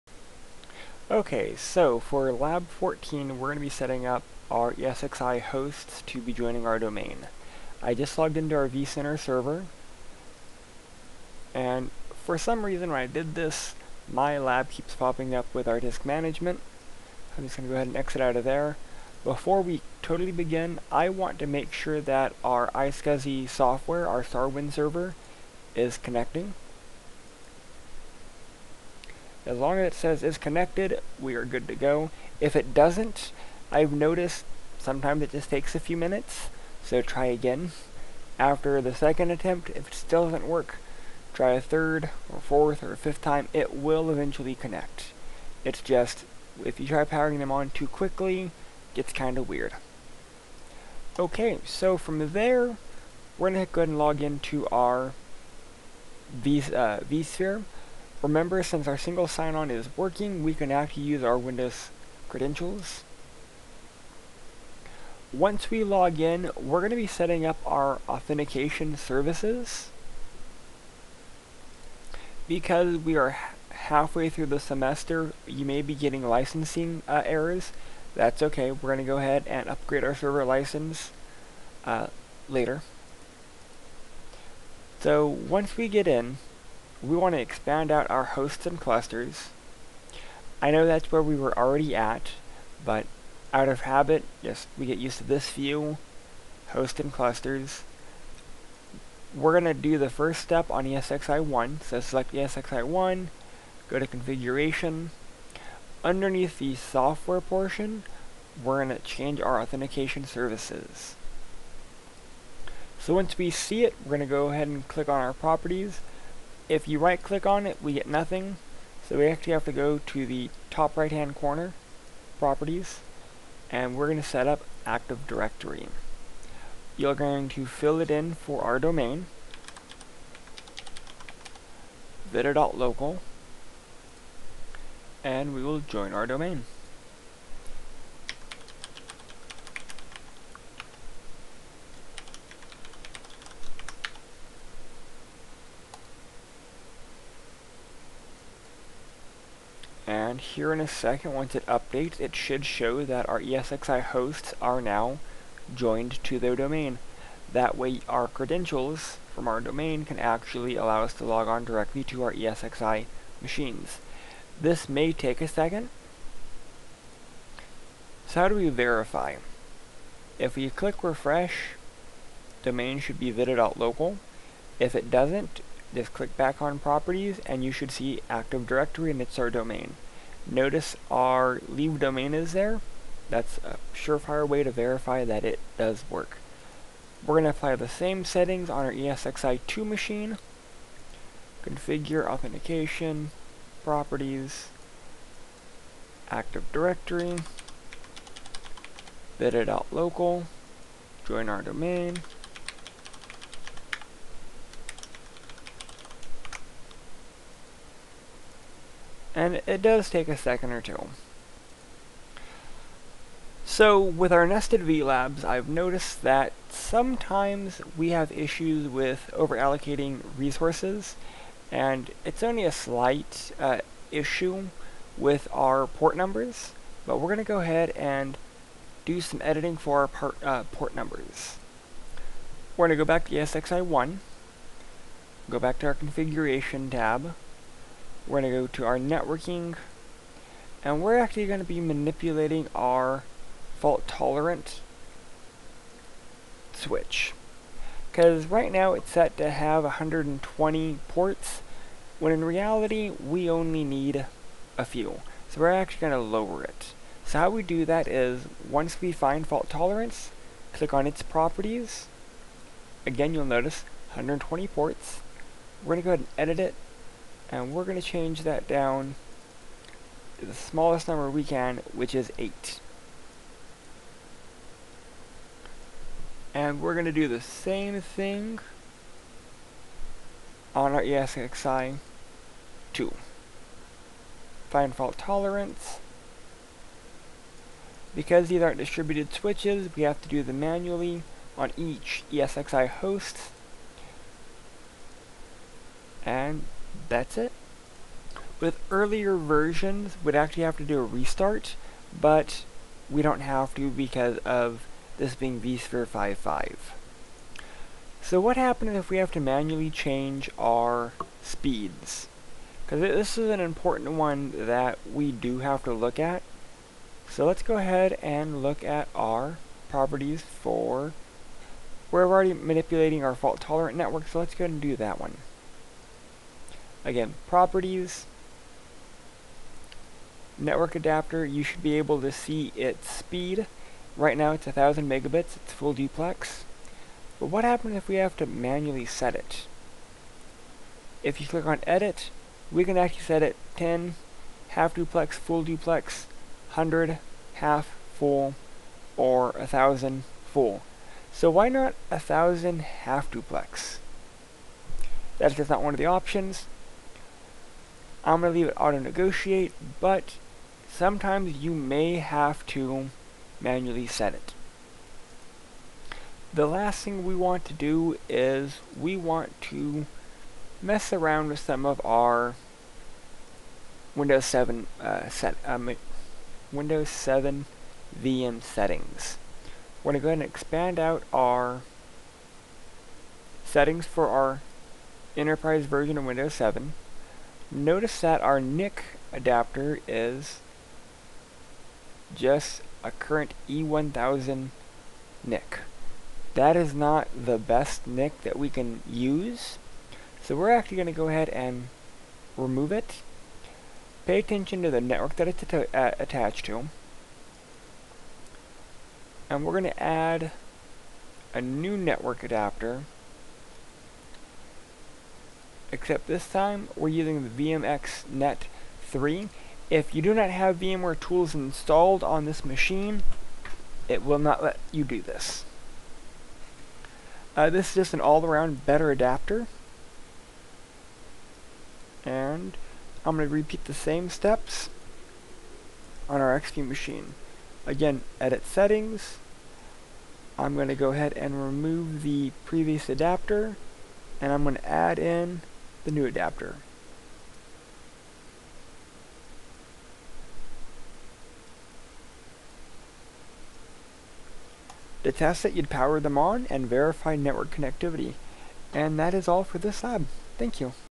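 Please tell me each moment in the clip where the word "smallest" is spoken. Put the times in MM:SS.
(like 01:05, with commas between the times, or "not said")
04:30.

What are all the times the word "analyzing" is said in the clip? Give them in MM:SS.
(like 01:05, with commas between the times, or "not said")
not said.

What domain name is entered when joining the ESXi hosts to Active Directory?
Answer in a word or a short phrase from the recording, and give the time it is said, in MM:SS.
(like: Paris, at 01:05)
vida.local, at 02:12.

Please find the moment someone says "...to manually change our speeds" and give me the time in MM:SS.
05:09.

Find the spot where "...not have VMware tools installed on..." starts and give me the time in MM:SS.
07:00.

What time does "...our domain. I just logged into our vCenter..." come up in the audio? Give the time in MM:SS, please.
00:06.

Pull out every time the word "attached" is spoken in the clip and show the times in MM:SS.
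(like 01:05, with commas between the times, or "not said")
06:46.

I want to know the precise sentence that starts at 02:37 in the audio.
That way our credentials from our domain can actually allow us to log on directly to our ESXi machines.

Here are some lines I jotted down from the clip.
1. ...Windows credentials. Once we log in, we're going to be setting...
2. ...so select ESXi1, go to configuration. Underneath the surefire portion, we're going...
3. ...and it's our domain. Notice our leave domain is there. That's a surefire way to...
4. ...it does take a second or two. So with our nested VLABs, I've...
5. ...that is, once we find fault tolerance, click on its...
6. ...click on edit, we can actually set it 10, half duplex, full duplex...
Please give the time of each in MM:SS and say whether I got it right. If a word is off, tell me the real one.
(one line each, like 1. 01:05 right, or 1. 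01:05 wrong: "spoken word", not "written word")
1. 01:01 right
2. 01:41 wrong: "software", not "surefire"
3. 02:59 right
4. 03:29 right
5. 04:17 right
6. 05:41 right.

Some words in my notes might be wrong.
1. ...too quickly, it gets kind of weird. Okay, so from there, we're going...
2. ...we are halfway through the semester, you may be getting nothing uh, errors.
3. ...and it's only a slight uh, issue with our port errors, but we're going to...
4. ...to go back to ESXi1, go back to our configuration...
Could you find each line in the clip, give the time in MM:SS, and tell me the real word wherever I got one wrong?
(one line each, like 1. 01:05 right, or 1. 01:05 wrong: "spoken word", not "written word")
1. 00:47 right
2. 01:12 wrong: "licensing", not "nothing"
3. 03:41 wrong: "numbers", not "errors"
4. 03:52 right.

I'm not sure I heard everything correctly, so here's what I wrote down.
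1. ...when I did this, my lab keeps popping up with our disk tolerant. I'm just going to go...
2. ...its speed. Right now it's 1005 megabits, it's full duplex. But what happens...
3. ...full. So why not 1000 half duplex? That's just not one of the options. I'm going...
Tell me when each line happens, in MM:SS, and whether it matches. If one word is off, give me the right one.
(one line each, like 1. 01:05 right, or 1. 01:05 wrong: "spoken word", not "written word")
1. 00:12 wrong: "management", not "tolerant"
2. 05:32 wrong: "1000", not "1005"
3. 05:50 right.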